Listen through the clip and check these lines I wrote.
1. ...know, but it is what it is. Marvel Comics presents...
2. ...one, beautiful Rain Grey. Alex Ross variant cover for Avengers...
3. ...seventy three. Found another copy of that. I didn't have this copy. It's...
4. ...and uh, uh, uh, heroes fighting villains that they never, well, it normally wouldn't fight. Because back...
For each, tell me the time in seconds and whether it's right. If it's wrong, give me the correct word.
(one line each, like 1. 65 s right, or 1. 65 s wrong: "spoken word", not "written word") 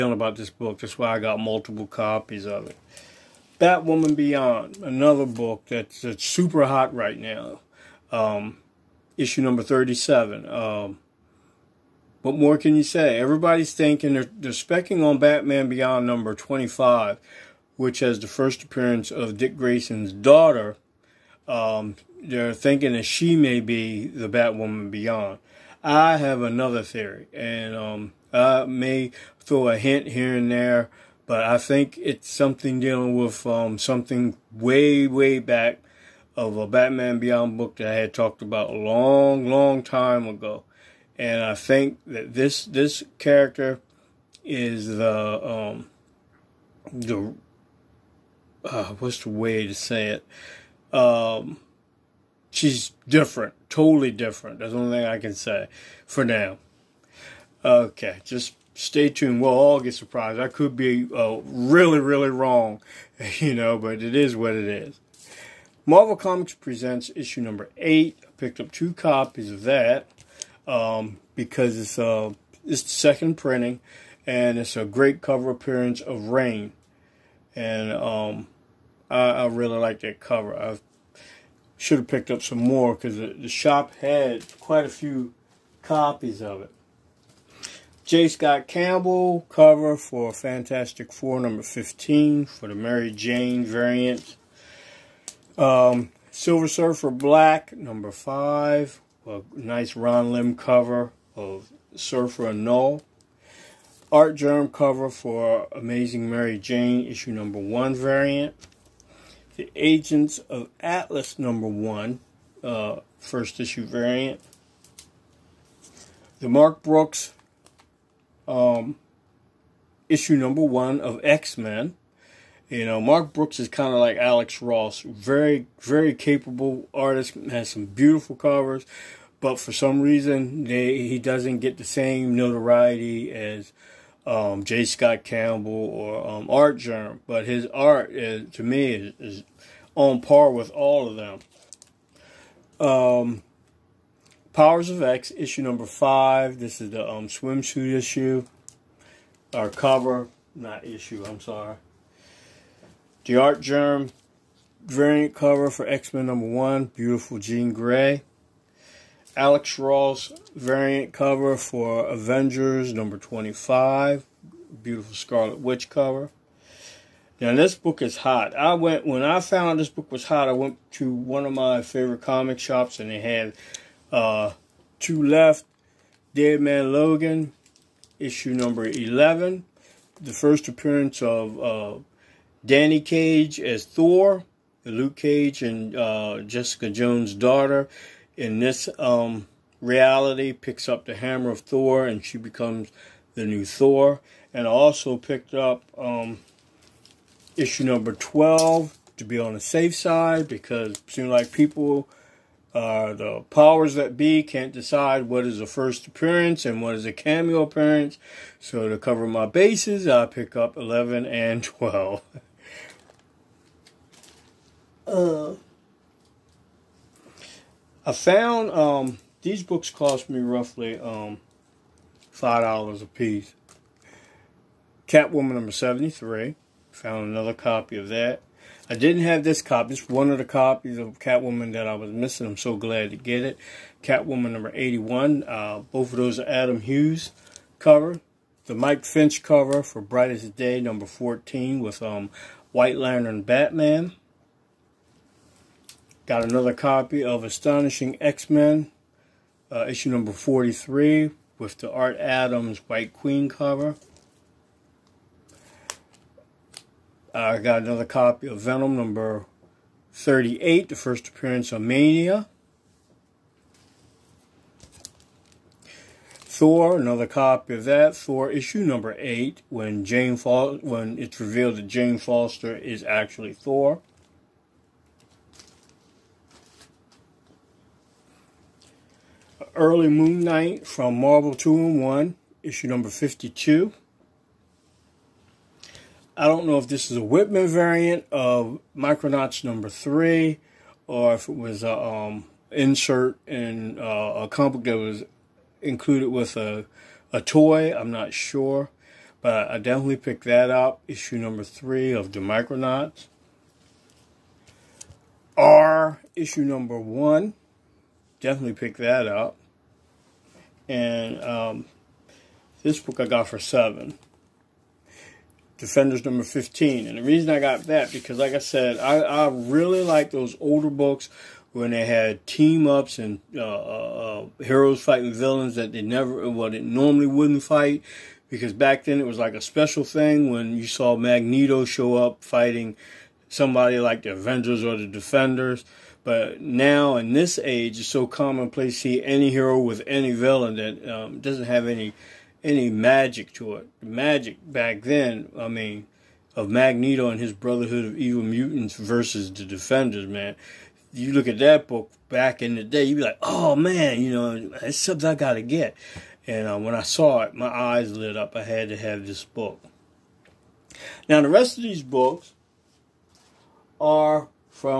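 1. 63 s right
2. 156 s wrong: "Jean", not "Rain"
3. 225 s right
4. 323 s right.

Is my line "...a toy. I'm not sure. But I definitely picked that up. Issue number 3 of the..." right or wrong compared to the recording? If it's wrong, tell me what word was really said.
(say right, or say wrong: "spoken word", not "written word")
right.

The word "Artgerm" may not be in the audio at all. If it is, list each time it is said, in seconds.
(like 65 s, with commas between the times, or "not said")
136 s, 153 s.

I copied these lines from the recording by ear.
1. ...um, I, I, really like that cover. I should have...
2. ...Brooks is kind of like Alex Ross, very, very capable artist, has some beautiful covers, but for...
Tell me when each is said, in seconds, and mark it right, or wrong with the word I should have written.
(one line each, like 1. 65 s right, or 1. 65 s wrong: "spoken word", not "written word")
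1. 77 s right
2. 123 s right.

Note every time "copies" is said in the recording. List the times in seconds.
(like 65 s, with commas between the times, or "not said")
1 s, 68 s, 85 s, 230 s.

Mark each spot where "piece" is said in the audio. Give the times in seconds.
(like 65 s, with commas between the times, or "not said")
223 s.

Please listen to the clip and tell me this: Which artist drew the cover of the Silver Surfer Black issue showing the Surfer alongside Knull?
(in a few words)
Ron Lim.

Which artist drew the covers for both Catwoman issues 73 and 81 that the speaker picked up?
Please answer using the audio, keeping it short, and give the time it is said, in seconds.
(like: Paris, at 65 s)
Adam Hughes, at 236 s.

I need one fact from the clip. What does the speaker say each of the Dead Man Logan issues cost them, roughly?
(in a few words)
$5.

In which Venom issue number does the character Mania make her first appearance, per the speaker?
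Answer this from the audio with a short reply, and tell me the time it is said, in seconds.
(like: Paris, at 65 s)
38, at 260 s.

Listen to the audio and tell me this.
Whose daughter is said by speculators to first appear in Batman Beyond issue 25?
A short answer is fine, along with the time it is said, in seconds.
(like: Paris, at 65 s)
Dick Grayson, at 19 s.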